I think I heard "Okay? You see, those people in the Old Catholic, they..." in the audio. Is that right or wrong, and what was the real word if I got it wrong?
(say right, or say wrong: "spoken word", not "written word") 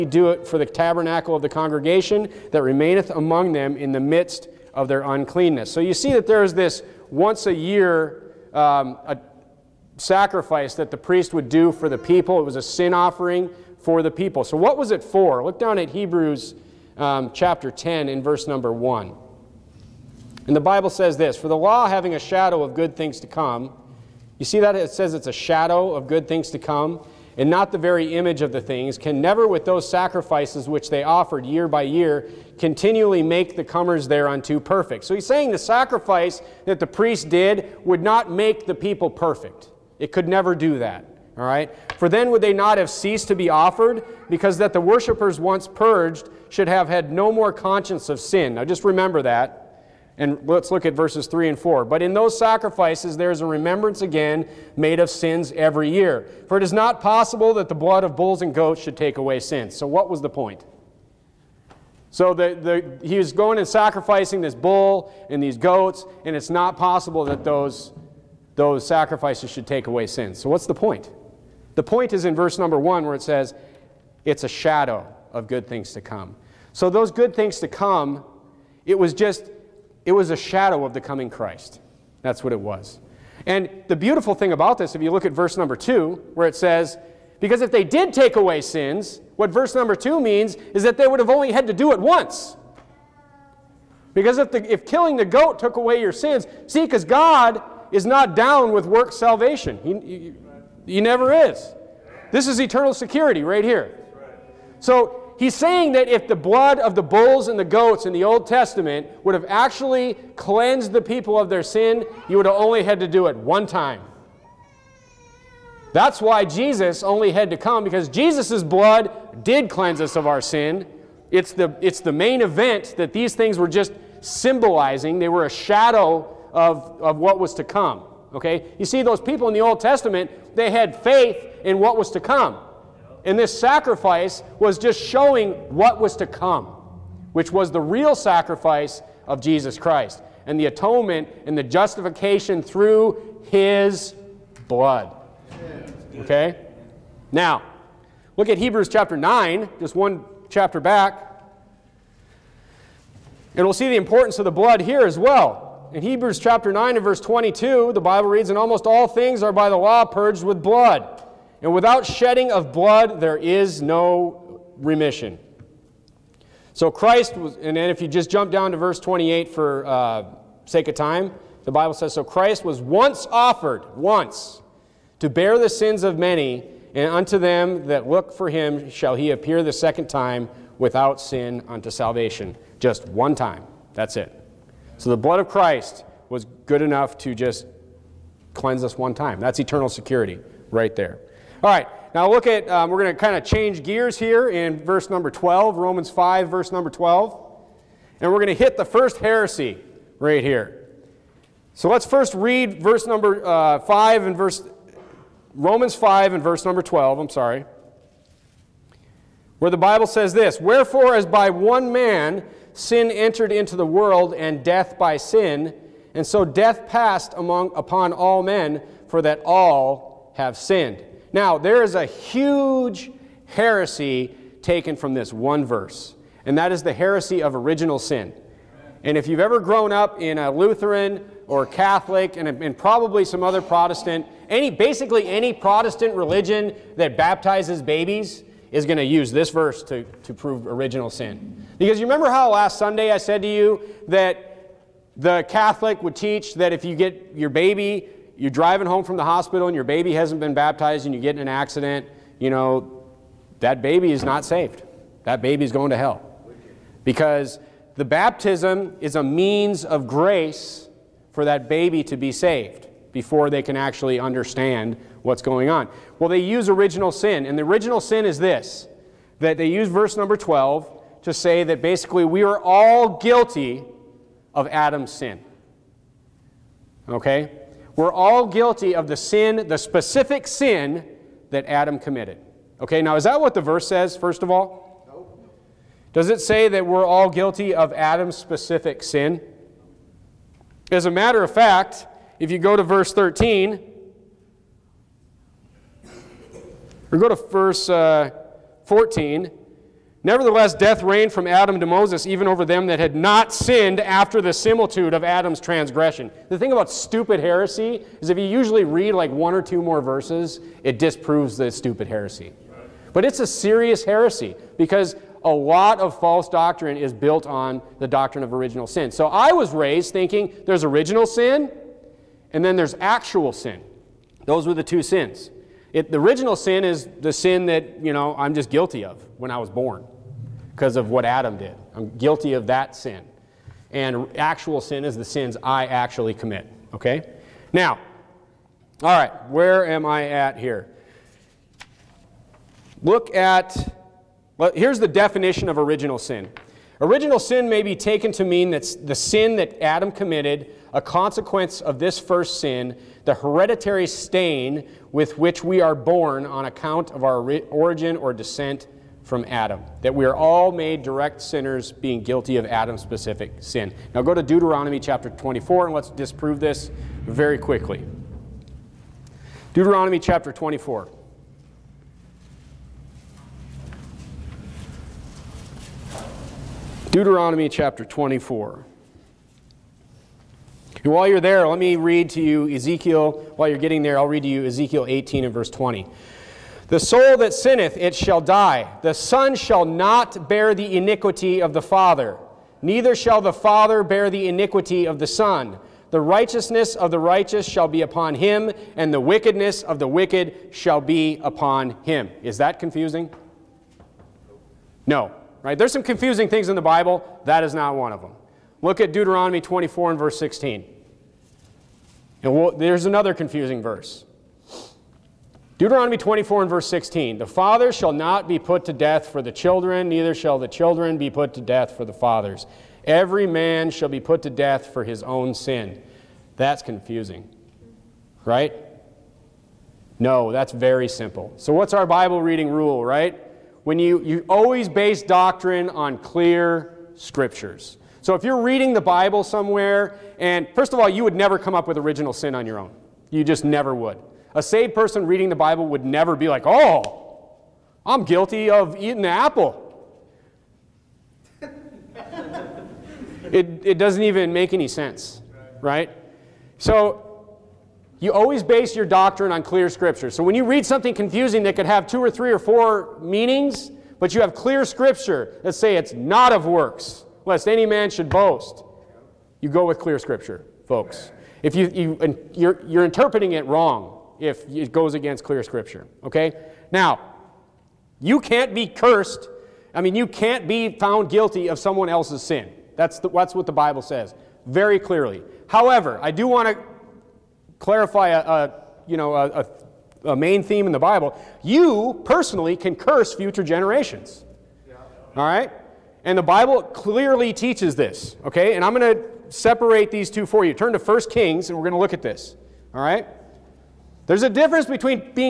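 wrong: "Testament", not "Catholic".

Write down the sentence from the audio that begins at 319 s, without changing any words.
So I was raised thinking there's original sin and then there's actual sin.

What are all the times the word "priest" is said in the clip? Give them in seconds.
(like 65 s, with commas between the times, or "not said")
10 s, 36 s.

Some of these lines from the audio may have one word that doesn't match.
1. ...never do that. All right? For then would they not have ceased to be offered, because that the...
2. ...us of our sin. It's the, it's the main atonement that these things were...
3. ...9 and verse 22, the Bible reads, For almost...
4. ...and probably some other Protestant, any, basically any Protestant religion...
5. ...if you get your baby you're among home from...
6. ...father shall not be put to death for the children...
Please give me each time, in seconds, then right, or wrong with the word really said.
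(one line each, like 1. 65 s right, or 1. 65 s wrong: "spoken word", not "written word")
1. 40 s right
2. 120 s wrong: "event", not "atonement"
3. 156 s wrong: "And", not "For"
4. 232 s right
5. 246 s wrong: "driving", not "among"
6. 417 s right.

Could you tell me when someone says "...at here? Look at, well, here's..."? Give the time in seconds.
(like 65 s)
340 s.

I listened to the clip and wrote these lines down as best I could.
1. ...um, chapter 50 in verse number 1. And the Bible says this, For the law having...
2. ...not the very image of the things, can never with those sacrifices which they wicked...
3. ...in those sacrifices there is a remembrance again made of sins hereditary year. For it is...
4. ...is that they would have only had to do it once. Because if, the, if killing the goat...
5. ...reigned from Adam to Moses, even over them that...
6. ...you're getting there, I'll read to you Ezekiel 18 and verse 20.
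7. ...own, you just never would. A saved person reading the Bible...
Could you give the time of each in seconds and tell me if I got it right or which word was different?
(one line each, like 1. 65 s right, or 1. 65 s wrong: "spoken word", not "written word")
1. 16 s wrong: "10", not "50"
2. 27 s wrong: "offered", not "wicked"
3. 52 s wrong: "every", not "hereditary"
4. 90 s right
5. 301 s right
6. 383 s right
7. 442 s right.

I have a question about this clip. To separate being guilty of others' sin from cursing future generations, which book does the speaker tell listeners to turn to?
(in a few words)
1 Kings.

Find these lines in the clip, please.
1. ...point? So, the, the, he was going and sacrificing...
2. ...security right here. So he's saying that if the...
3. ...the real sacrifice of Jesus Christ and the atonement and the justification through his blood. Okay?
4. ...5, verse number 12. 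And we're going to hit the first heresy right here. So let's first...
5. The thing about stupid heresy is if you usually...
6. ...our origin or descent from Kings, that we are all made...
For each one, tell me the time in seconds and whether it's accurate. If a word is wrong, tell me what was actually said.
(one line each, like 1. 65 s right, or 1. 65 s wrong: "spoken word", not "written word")
1. 60 s right
2. 102 s right
3. 137 s right
4. 196 s right
5. 306 s right
6. 357 s wrong: "Adam", not "Kings".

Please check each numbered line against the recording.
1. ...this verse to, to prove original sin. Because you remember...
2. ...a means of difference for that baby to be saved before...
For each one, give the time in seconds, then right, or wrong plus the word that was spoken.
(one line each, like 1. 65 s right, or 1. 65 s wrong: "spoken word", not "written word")
1. 239 s right
2. 259 s wrong: "grace", not "difference".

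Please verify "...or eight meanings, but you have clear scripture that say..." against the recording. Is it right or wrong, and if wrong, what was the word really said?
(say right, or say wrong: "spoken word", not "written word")
wrong: "four", not "eight".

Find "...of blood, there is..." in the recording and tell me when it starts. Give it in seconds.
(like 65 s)
162 s.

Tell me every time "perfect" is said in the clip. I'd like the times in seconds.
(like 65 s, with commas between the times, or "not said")
34 s, 39 s.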